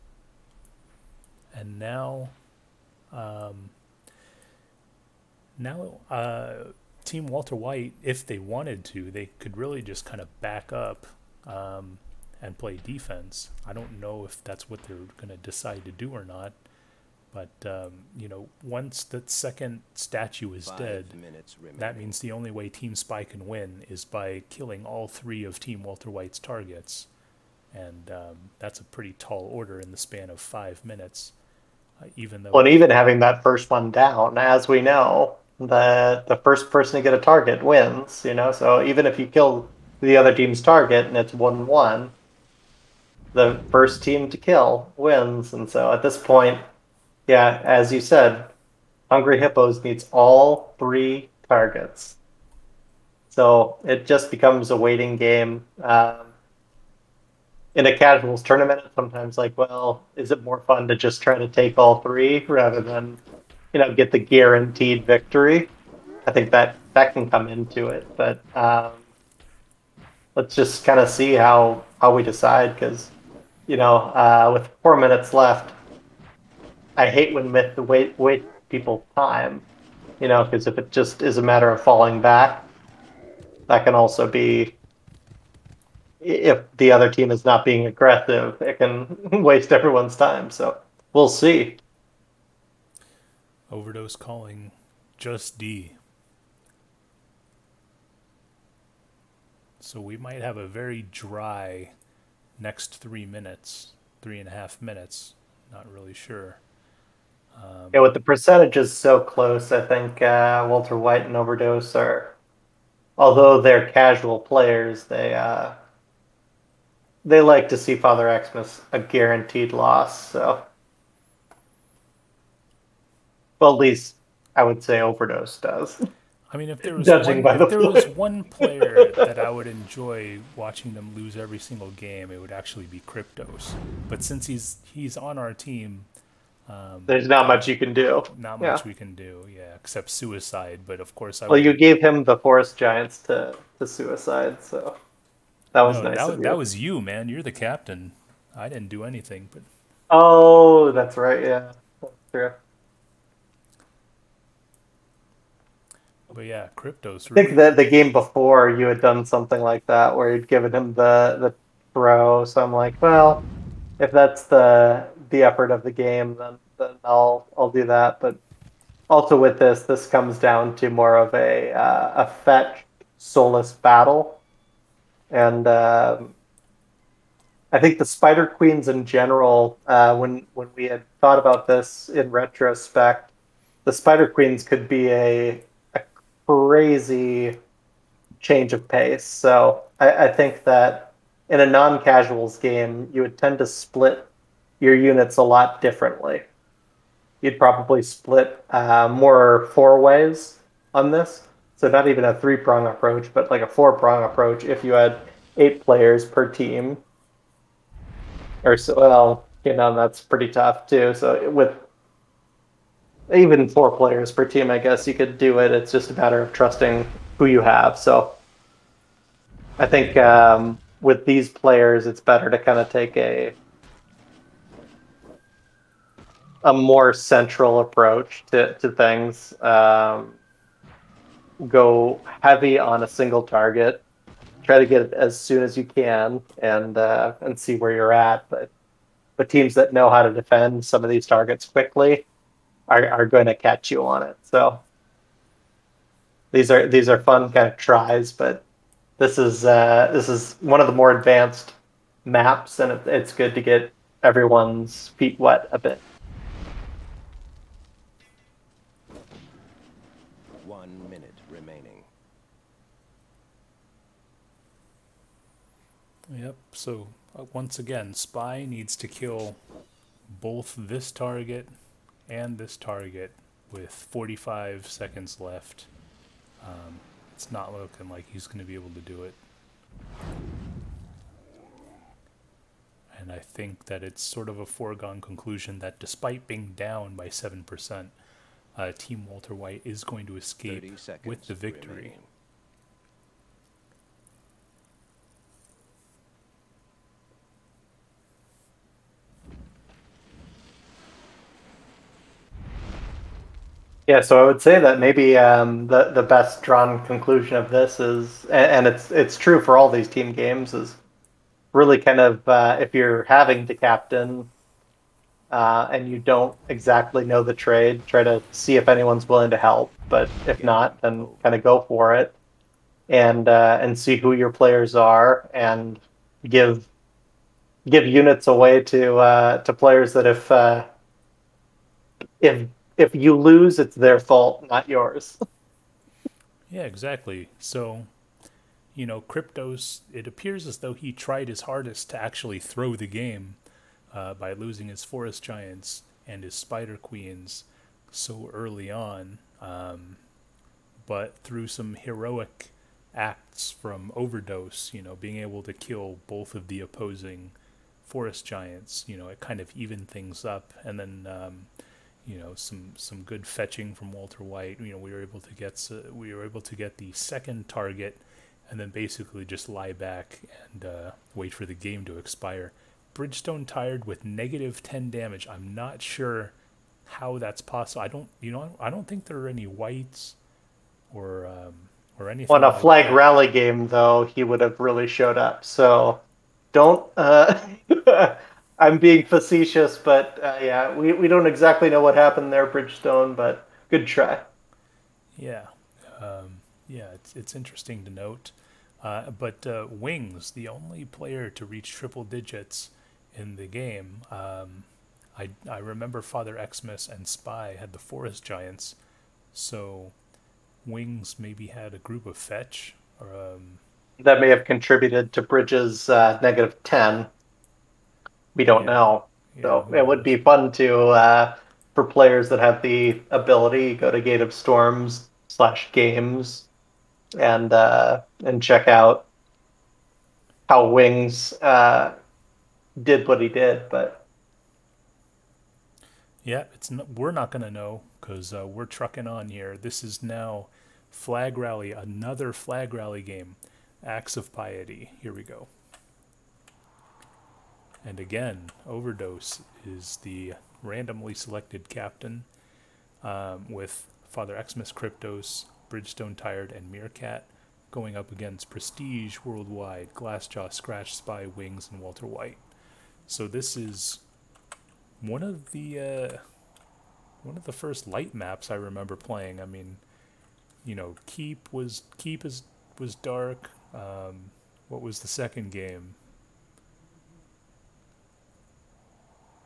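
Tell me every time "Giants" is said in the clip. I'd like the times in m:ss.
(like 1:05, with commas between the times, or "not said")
2:22, 5:45, 5:58, 6:48.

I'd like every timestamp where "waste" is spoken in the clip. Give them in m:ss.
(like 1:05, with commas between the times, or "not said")
1:29.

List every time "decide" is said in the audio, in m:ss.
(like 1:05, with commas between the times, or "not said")
0:15, 1:12.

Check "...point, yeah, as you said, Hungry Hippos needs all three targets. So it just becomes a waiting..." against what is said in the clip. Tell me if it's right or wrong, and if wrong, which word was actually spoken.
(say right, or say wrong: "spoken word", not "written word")
right.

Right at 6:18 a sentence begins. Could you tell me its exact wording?
I don't you know I don't think there are any wights or um, or anything.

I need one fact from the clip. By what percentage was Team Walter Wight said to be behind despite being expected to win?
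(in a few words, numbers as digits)
7%.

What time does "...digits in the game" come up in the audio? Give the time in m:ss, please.
6:42.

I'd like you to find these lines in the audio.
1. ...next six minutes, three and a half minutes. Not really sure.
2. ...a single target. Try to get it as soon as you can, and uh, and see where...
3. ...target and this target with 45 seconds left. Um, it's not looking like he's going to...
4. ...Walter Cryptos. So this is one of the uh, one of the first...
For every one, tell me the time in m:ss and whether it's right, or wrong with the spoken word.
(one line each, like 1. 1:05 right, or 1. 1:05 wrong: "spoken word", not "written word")
1. 1:42 wrong: "three", not "six"
2. 3:53 right
3. 4:31 right
4. 7:42 wrong: "Wight", not "Cryptos".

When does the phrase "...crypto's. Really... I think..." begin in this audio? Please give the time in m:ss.
2:36.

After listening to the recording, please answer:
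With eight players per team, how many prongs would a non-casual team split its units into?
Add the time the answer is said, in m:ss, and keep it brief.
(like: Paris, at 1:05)
4, at 3:23.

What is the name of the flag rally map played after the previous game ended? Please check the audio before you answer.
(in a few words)
Acts of Piety.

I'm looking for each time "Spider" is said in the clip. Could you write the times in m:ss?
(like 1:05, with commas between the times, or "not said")
2:58, 3:03, 5:46.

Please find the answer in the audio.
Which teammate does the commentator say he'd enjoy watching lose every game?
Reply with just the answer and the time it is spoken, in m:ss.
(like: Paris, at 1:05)
Kryptos, at 2:13.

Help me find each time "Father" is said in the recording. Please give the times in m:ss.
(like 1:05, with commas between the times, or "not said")
1:57, 6:46, 7:34.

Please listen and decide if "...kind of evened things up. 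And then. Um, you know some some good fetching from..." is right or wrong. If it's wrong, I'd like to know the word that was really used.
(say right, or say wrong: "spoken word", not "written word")
right.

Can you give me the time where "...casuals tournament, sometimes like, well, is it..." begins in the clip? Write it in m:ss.
0:57.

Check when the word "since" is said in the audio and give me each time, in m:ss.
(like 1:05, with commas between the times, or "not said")
2:14.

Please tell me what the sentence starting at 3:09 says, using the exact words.
So I, I think that in a non casuals game, you would tend to split your units a lot differently.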